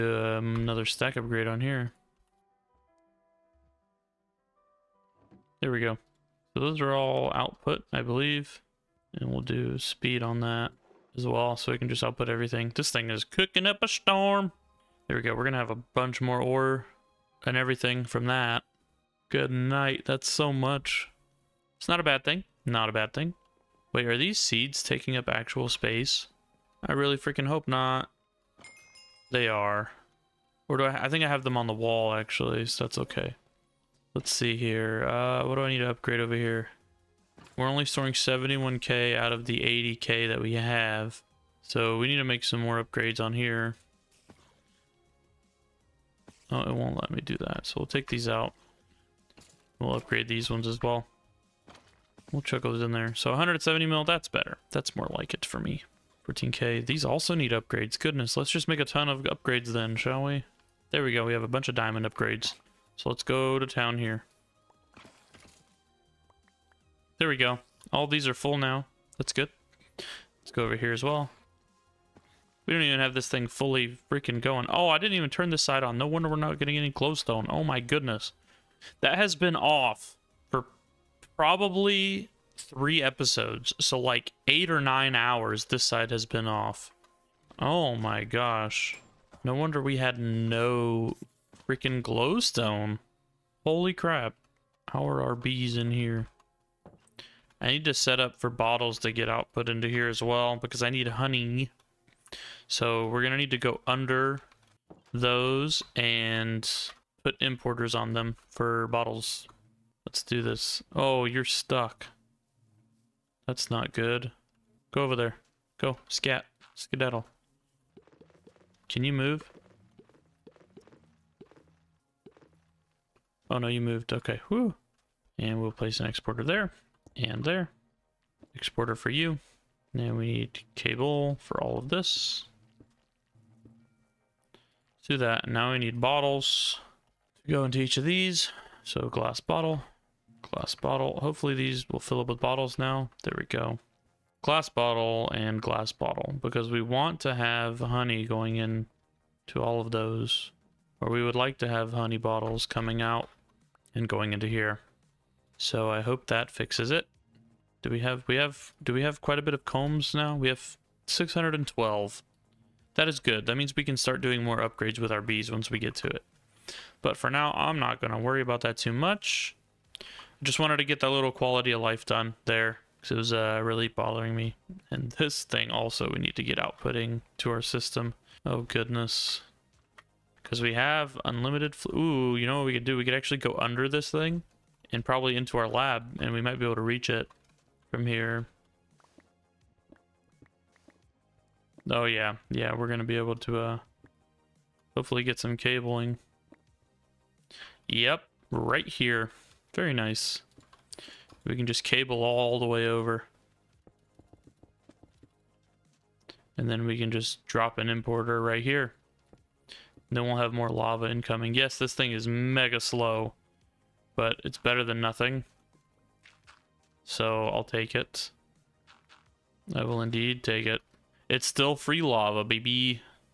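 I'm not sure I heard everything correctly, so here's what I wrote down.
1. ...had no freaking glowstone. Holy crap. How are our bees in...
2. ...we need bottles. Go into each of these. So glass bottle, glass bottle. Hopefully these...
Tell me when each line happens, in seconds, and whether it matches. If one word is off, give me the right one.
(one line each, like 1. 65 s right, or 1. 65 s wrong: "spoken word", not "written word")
1. 89 s right
2. 135 s right.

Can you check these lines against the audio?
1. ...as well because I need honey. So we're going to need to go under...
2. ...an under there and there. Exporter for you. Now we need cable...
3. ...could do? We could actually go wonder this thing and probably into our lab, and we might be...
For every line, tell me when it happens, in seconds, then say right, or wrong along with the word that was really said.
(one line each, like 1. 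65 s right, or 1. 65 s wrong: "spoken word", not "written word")
1. 100 s right
2. 125 s wrong: "exporter", not "under"
3. 182 s wrong: "under", not "wonder".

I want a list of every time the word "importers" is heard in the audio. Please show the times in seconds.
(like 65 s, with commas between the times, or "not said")
107 s, 207 s.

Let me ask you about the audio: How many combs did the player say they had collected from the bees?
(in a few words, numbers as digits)
612.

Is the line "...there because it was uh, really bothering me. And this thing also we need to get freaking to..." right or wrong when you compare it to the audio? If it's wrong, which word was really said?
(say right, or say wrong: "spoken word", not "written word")
wrong: "outputting", not "freaking".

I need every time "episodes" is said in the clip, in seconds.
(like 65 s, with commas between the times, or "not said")
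83 s.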